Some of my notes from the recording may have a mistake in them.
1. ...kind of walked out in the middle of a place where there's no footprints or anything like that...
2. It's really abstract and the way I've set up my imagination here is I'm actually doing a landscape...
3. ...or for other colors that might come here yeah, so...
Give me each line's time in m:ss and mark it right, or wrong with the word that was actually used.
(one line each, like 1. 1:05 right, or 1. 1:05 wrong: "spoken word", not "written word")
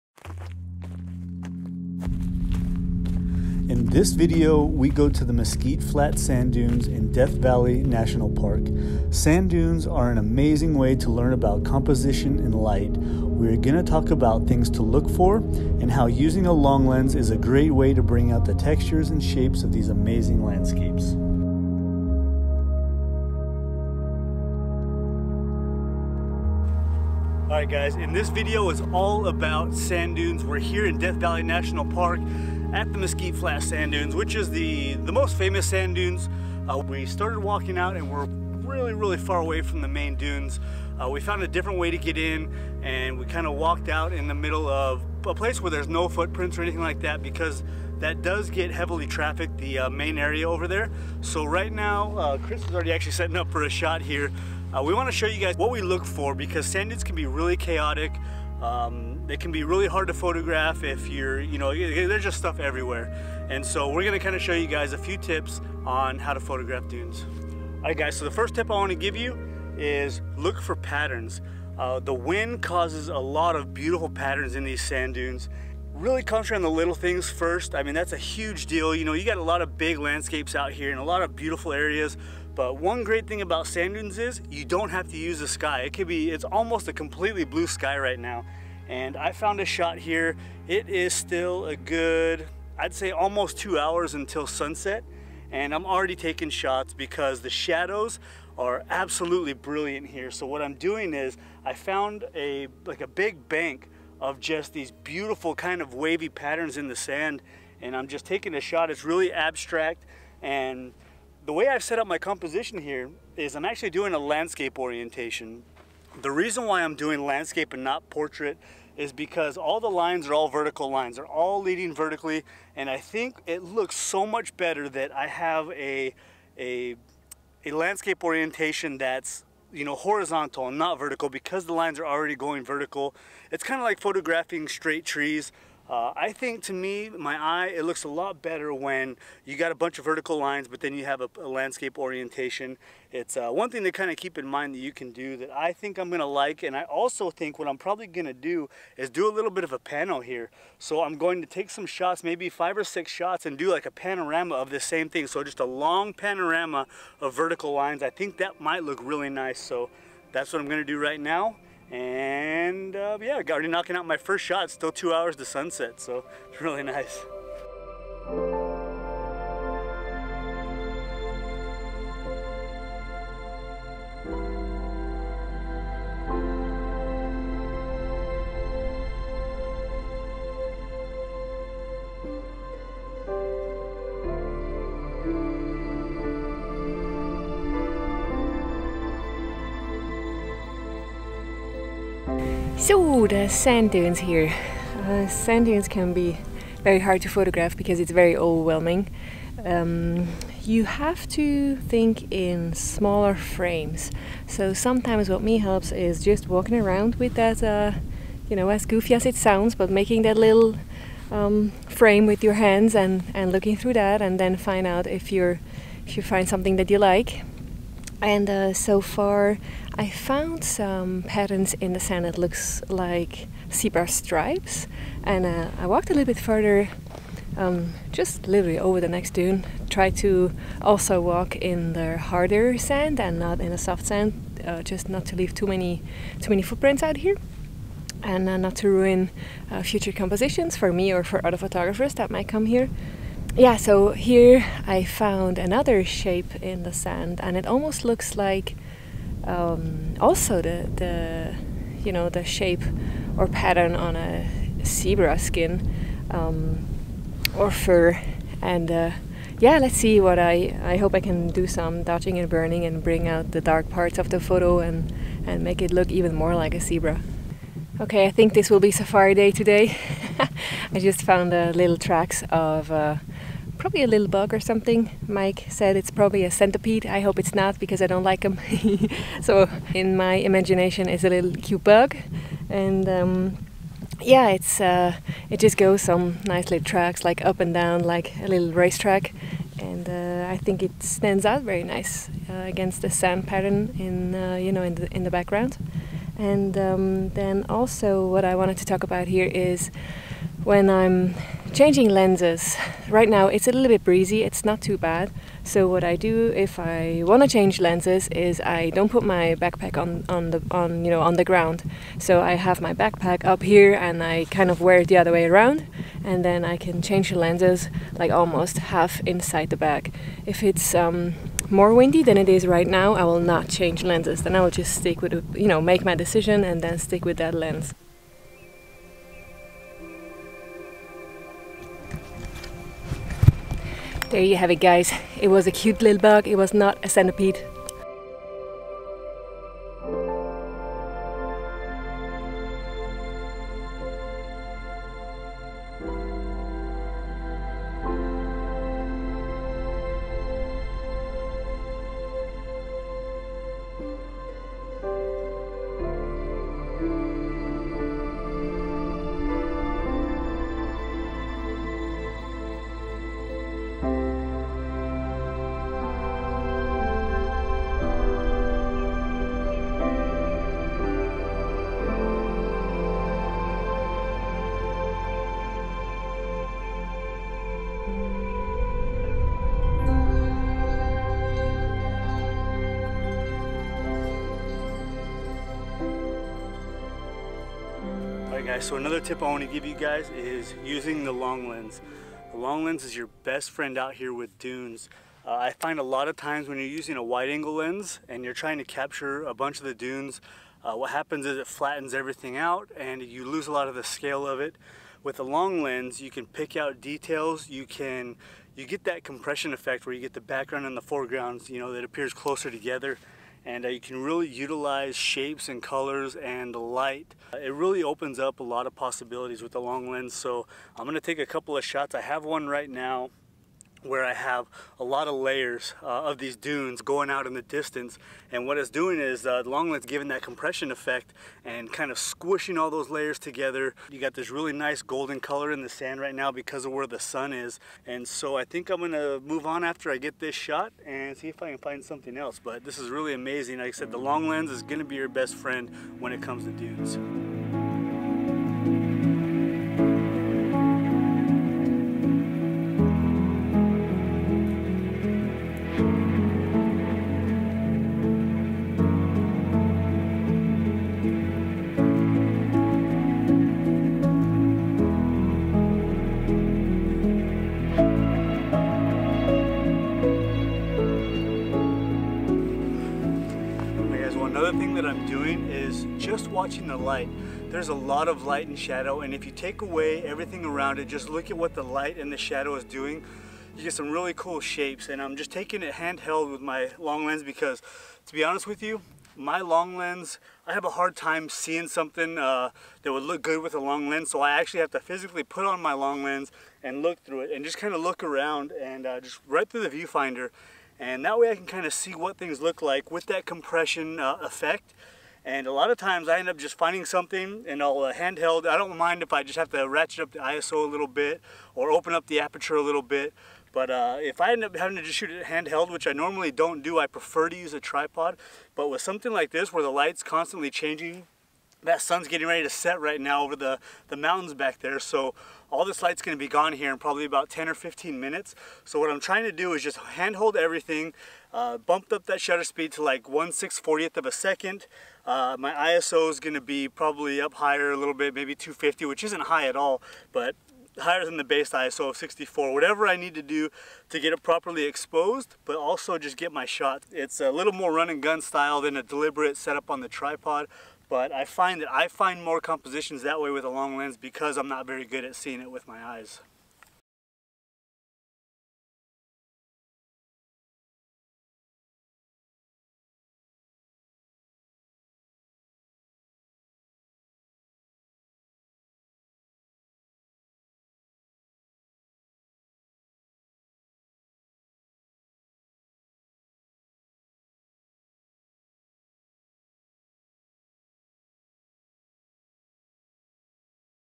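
1. 0:43 right
2. 1:48 wrong: "composition", not "imagination"
3. 4:01 wrong: "photographers", not "colors".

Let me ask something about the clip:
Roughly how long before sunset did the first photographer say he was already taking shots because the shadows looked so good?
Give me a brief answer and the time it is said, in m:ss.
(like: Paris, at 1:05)
almost two hours, at 1:33.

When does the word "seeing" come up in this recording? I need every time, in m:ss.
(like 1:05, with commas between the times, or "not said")
8:11, 9:15.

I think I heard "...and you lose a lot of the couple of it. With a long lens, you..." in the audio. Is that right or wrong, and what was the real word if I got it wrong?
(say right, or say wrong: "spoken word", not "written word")
wrong: "scale", not "couple".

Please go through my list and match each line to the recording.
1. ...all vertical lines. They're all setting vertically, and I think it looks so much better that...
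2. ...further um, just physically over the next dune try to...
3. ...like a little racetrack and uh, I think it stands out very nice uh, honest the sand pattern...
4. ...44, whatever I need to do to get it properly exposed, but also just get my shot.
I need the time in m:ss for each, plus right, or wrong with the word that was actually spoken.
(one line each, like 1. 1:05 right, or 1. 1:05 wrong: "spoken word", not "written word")
1. 2:00 wrong: "leading", not "setting"
2. 3:46 wrong: "literally", not "physically"
3. 4:48 wrong: "against", not "honest"
4. 9:02 wrong: "64", not "44".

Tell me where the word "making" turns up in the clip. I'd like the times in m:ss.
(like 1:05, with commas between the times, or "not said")
3:29.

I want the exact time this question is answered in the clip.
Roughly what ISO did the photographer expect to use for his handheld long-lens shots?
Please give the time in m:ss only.
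8:58.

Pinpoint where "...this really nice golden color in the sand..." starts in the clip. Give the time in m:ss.
7:14.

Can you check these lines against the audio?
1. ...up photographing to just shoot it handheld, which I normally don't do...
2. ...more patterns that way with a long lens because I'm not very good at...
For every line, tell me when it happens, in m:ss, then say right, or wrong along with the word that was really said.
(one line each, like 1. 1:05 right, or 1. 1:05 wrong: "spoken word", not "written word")
1. 8:34 wrong: "having", not "photographing"
2. 9:12 wrong: "compositions", not "patterns".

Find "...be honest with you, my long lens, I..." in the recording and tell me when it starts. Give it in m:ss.
8:08.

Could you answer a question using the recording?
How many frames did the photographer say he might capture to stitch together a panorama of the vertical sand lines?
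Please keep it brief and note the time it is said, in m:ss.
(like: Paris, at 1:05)
5 or 6, at 2:32.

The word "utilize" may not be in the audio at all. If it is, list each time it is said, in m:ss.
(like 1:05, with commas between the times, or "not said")
6:54.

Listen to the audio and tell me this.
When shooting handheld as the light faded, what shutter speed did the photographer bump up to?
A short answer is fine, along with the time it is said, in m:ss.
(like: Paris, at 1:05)
1/640 second, at 8:53.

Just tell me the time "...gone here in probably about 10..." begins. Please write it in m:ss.
8:46.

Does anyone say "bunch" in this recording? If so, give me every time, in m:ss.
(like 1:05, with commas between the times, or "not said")
2:19, 6:39.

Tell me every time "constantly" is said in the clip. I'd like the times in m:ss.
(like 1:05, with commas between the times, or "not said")
8:40.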